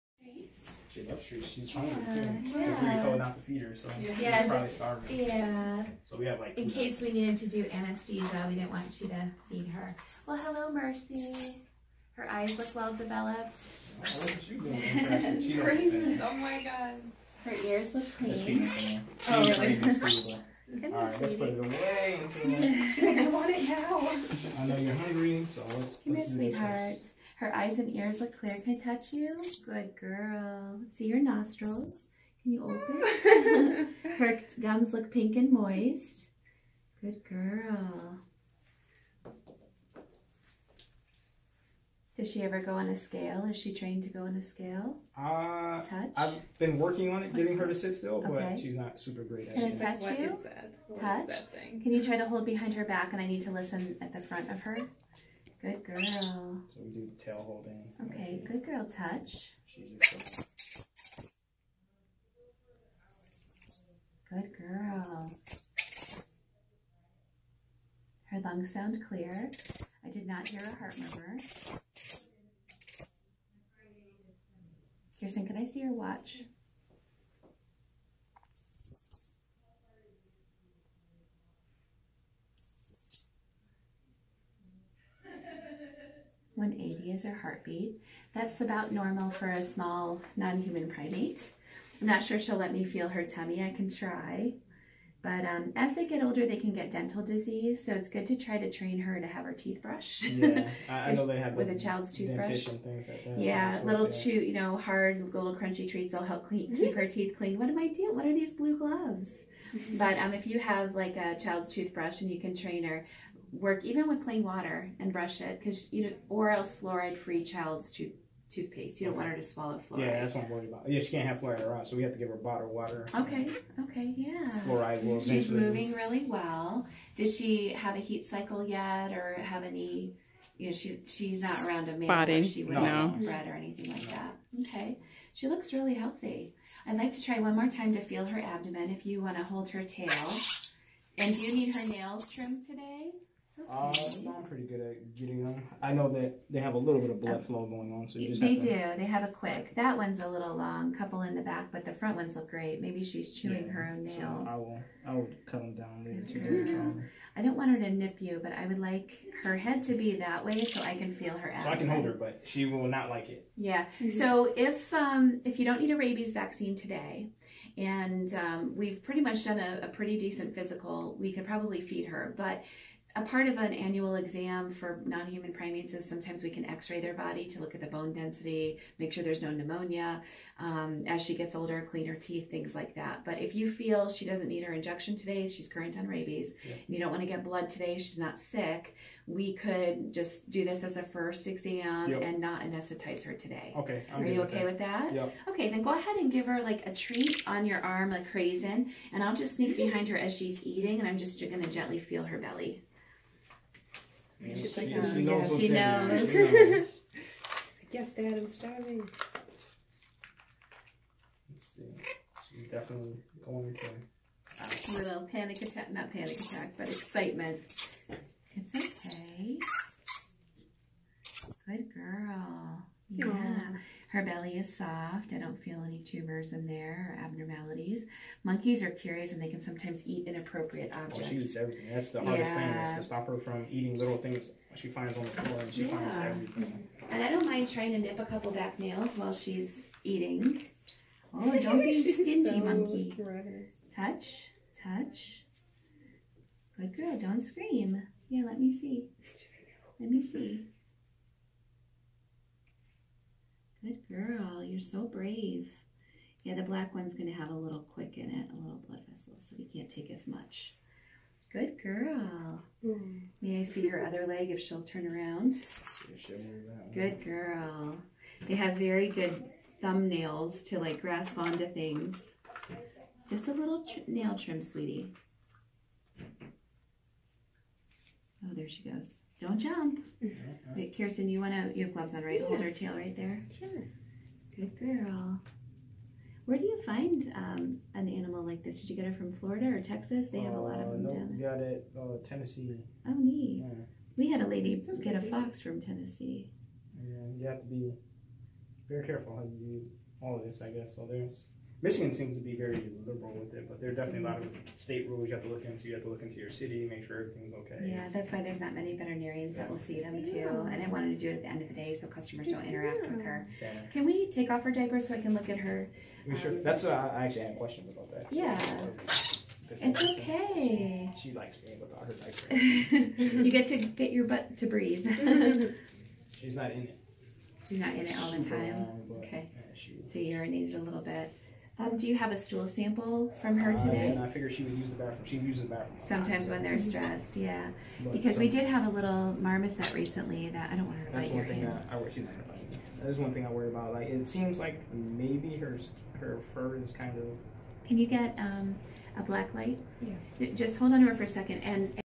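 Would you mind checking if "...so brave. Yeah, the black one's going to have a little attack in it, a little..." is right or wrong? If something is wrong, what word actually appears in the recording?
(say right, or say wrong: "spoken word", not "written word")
wrong: "quick", not "attack".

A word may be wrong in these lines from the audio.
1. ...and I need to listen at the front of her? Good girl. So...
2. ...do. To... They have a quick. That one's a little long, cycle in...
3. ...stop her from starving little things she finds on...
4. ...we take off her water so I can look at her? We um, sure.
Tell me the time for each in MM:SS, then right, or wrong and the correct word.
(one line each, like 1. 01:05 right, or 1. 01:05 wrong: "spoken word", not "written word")
1. 00:53 right
2. 02:28 wrong: "couple", not "cycle"
3. 03:53 wrong: "eating", not "starving"
4. 05:14 wrong: "diaper", not "water".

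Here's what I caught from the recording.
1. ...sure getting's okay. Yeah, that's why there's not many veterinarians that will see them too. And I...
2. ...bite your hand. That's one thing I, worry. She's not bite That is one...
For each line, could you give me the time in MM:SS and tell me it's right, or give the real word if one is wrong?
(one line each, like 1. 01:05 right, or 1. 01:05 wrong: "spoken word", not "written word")
1. 05:07 wrong: "everything", not "getting"
2. 05:41 right.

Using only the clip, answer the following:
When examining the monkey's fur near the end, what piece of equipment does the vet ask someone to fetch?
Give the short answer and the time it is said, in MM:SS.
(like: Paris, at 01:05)
black light, at 05:49.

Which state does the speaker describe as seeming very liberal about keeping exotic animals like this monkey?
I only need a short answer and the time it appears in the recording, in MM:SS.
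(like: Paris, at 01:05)
Michigan, at 05:01.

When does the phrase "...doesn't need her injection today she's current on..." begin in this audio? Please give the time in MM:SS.
03:04.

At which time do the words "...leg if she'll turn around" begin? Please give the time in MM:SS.
04:24.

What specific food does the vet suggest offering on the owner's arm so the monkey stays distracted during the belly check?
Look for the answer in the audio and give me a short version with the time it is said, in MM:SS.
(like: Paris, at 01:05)
raisin, at 03:18.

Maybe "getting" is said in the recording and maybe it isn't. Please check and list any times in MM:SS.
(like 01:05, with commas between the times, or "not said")
00:47, 02:25.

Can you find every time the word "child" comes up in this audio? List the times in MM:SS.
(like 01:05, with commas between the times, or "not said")
01:41, 01:51, 01:57.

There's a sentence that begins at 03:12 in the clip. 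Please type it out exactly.
and not anesthetize her today okay I'm are you okay with that, with that?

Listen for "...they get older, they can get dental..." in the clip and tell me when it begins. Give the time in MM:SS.
01:35.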